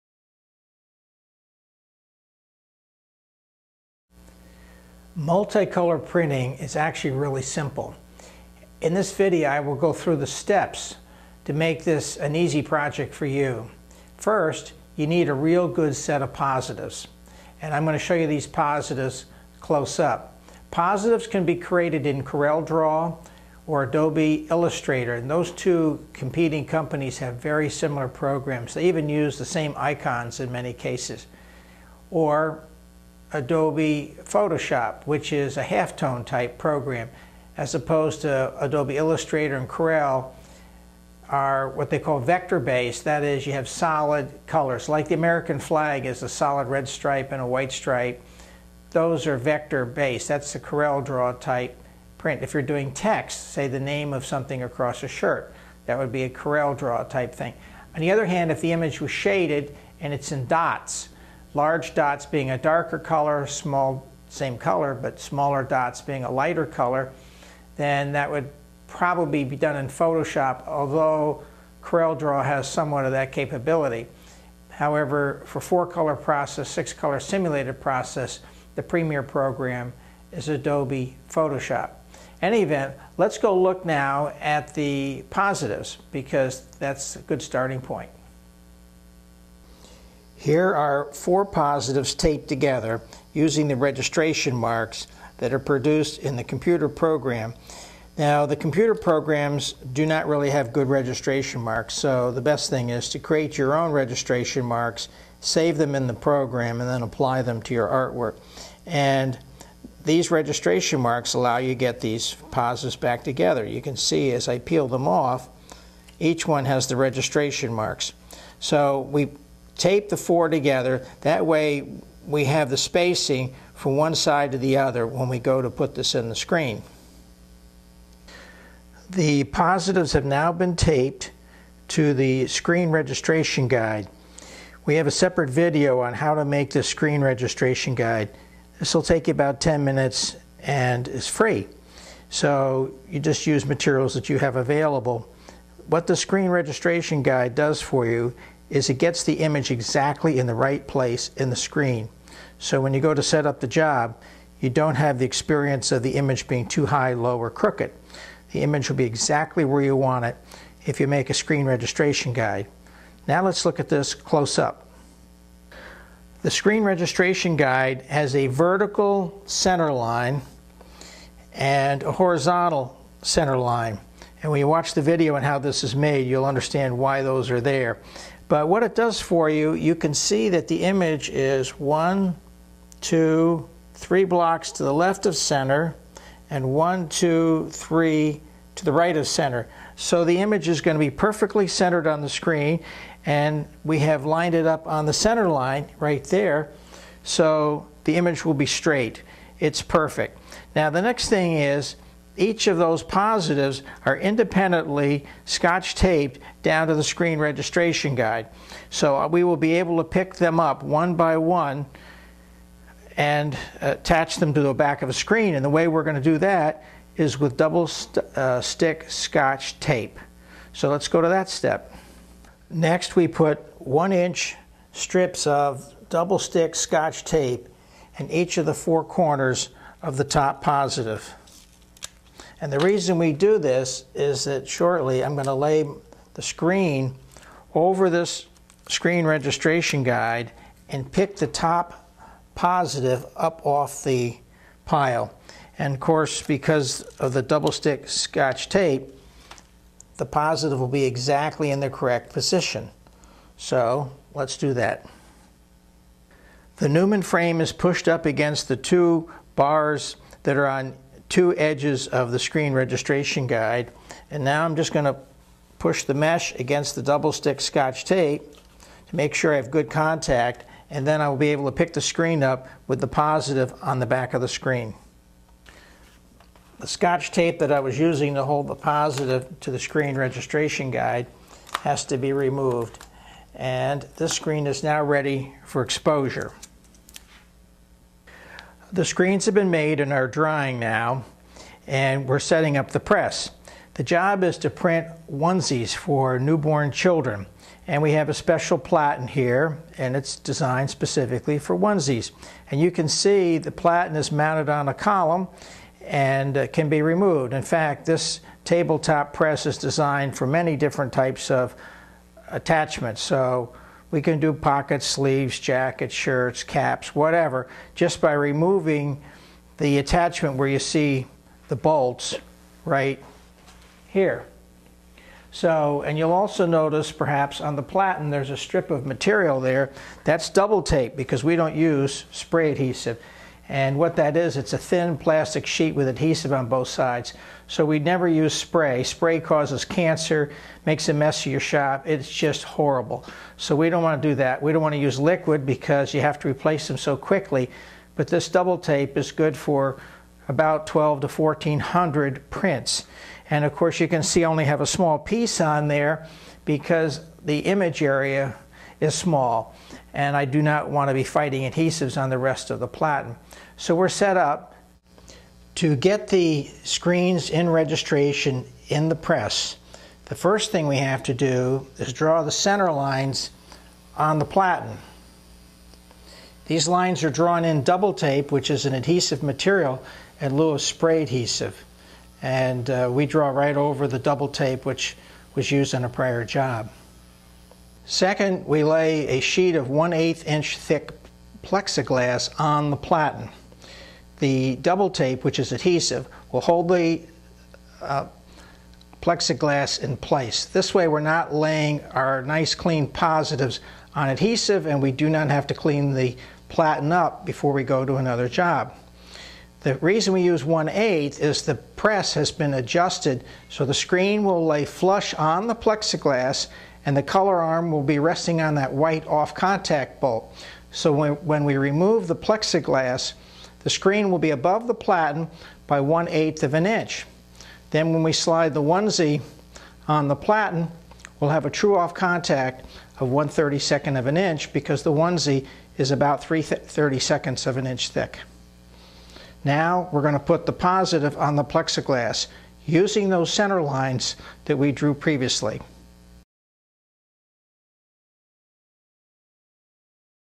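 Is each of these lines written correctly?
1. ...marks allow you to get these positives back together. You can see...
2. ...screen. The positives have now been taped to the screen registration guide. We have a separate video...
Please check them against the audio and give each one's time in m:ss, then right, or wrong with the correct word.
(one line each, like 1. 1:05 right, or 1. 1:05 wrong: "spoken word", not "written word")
1. 1:51 right
2. 2:06 right.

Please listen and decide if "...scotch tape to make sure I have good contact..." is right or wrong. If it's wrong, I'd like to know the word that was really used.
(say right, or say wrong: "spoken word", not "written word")
right.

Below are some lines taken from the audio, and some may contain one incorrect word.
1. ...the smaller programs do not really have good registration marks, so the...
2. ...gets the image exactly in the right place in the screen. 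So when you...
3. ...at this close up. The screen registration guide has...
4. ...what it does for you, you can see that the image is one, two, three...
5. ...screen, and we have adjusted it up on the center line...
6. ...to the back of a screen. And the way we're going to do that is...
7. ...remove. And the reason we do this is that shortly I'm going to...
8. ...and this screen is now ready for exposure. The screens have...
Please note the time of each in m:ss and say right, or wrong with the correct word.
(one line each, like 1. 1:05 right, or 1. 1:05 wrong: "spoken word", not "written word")
1. 1:38 wrong: "computer", not "smaller"
2. 2:28 right
3. 2:43 right
4. 2:58 right
5. 3:12 wrong: "lined", not "adjusted"
6. 3:34 right
7. 3:50 wrong: "positive", not "remove"
8. 4:43 right.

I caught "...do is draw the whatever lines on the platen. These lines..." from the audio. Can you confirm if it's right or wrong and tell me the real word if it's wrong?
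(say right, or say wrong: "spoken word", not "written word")
wrong: "center", not "whatever".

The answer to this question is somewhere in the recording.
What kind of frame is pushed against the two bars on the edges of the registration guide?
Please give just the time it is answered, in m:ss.
4:16.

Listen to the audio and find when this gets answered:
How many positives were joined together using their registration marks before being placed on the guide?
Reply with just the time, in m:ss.
1:30.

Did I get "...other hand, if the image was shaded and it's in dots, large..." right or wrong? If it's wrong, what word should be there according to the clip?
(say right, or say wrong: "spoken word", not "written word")
right.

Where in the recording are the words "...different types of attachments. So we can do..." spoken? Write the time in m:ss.
5:10.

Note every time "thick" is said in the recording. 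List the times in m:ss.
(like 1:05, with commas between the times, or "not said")
6:30, 7:18.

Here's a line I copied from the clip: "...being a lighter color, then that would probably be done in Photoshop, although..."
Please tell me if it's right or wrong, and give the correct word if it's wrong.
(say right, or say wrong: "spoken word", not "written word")
right.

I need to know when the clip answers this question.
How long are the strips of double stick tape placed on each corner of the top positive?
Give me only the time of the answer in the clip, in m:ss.
3:43.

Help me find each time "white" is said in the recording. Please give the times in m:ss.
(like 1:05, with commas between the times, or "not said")
0:47, 6:58.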